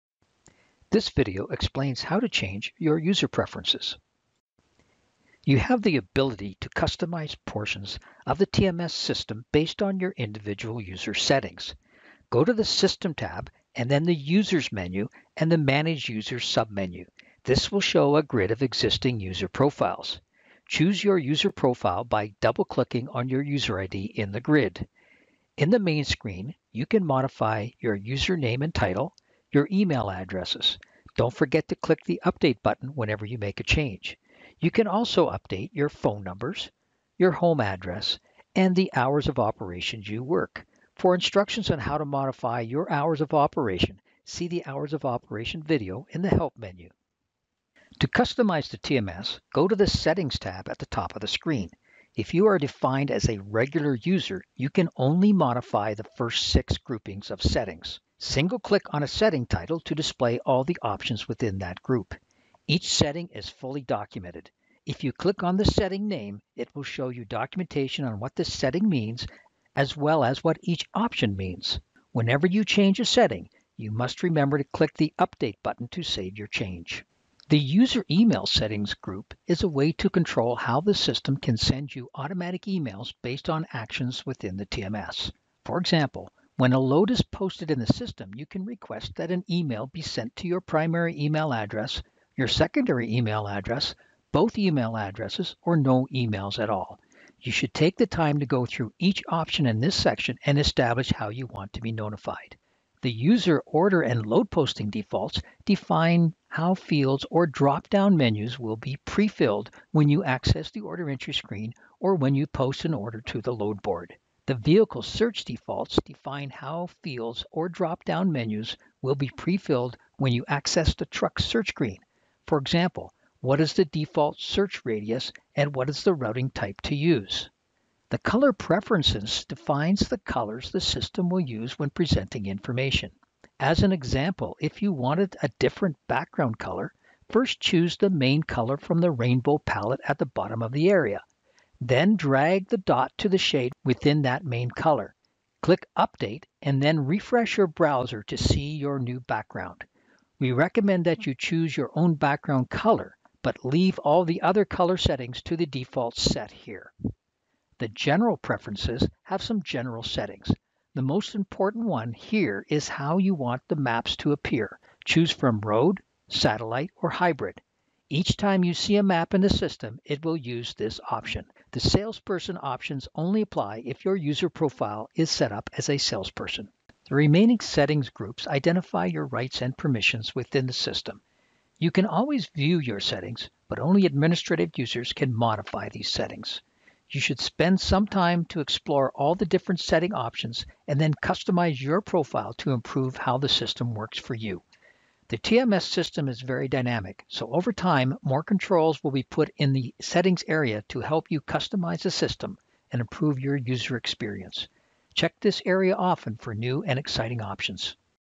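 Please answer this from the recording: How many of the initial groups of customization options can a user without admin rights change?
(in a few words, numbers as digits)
6.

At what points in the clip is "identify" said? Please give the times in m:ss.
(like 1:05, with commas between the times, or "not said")
2:58.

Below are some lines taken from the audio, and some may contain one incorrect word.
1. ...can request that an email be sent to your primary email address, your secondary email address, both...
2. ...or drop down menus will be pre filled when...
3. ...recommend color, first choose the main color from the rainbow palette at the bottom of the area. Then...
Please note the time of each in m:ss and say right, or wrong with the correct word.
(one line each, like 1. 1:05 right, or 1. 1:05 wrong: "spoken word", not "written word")
1. 1:28 right
2. 1:47 right
3. 2:16 wrong: "background", not "recommend".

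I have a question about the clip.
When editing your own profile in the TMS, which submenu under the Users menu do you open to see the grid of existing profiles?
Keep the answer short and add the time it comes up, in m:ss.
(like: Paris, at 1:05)
Manage Users, at 0:15.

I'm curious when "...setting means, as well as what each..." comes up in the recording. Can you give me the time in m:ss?
1:08.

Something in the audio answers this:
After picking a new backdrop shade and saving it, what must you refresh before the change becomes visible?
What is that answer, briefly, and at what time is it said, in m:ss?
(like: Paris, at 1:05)
your browser, at 2:27.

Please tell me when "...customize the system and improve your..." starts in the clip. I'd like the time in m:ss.
3:21.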